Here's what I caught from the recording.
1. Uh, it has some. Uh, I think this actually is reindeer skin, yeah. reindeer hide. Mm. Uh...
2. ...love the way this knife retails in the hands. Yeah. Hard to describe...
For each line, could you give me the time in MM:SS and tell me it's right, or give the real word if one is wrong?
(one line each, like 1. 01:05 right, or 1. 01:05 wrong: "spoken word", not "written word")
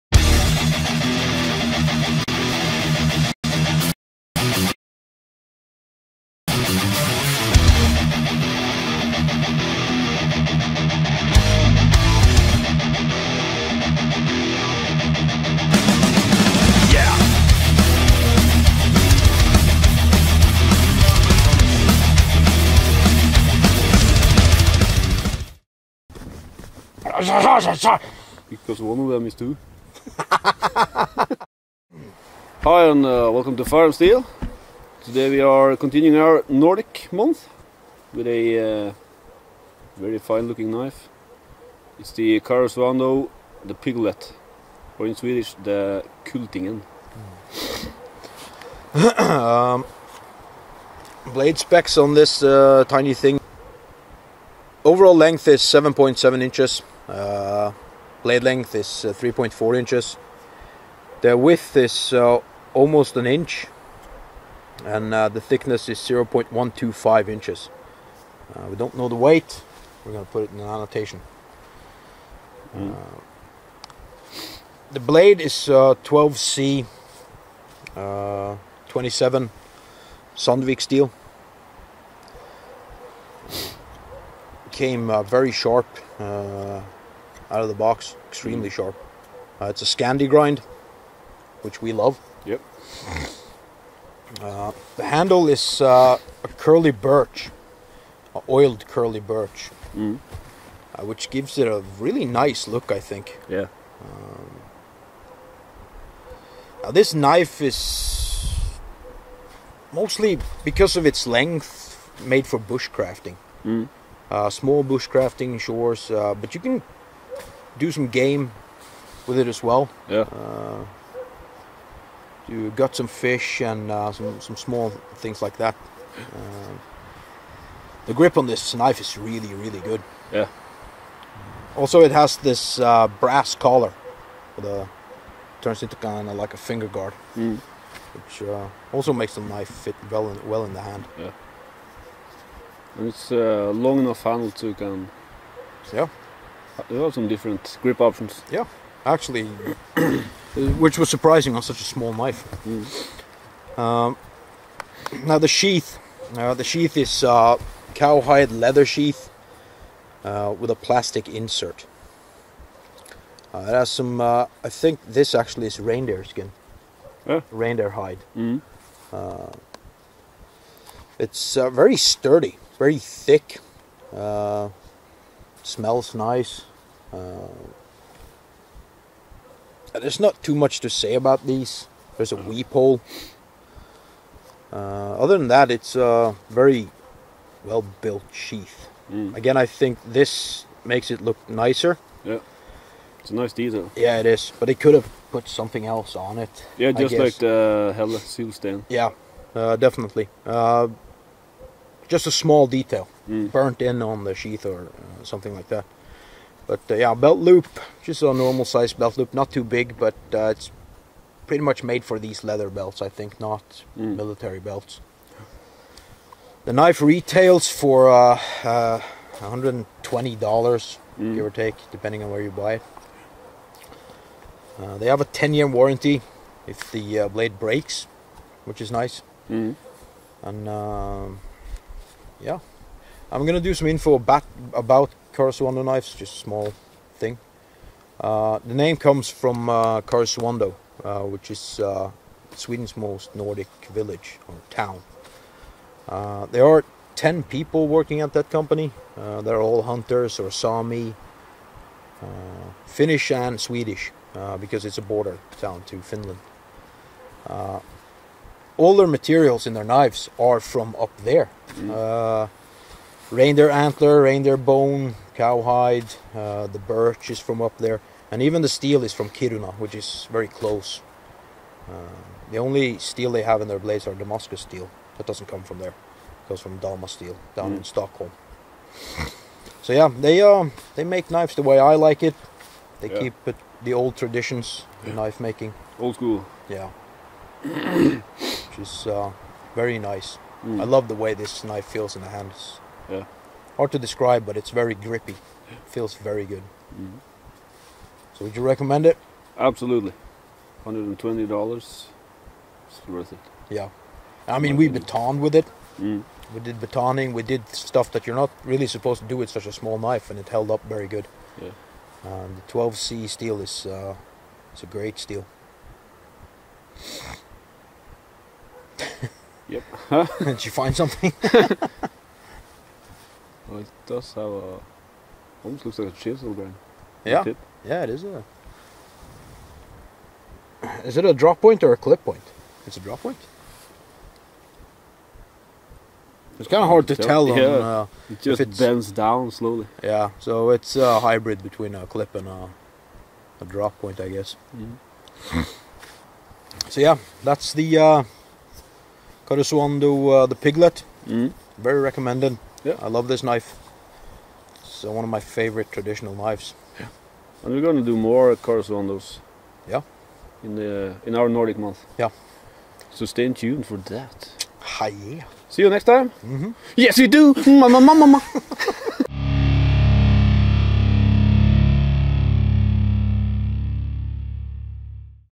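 1. 02:43 right
2. 04:50 wrong: "feels", not "retails".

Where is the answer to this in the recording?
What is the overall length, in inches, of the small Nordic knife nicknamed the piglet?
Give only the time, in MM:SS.
00:55.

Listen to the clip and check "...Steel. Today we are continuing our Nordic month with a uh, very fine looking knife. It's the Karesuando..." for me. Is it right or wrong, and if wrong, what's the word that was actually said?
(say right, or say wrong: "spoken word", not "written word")
right.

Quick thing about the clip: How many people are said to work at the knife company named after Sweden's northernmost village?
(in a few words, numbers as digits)
10.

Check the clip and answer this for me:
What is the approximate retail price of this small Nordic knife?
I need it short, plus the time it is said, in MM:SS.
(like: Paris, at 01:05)
$120, at 03:39.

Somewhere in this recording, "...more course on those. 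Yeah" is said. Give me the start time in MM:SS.
05:58.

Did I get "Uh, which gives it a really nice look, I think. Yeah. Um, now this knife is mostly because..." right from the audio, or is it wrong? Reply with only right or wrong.
right.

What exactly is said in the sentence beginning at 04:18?
all their materials in their knives are from up there.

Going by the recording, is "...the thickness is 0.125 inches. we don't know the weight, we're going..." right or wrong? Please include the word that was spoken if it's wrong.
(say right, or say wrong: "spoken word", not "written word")
right.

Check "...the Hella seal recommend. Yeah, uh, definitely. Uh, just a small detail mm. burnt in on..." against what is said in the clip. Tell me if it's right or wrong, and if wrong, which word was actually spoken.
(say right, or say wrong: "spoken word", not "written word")
wrong: "stand", not "recommend".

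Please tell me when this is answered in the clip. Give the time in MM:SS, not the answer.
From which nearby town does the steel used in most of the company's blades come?
04:29.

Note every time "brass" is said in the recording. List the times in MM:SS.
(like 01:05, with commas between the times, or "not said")
02:13.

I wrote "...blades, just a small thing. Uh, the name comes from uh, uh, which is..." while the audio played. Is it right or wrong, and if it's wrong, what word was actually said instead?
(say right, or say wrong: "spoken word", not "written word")
wrong: "knives", not "blades".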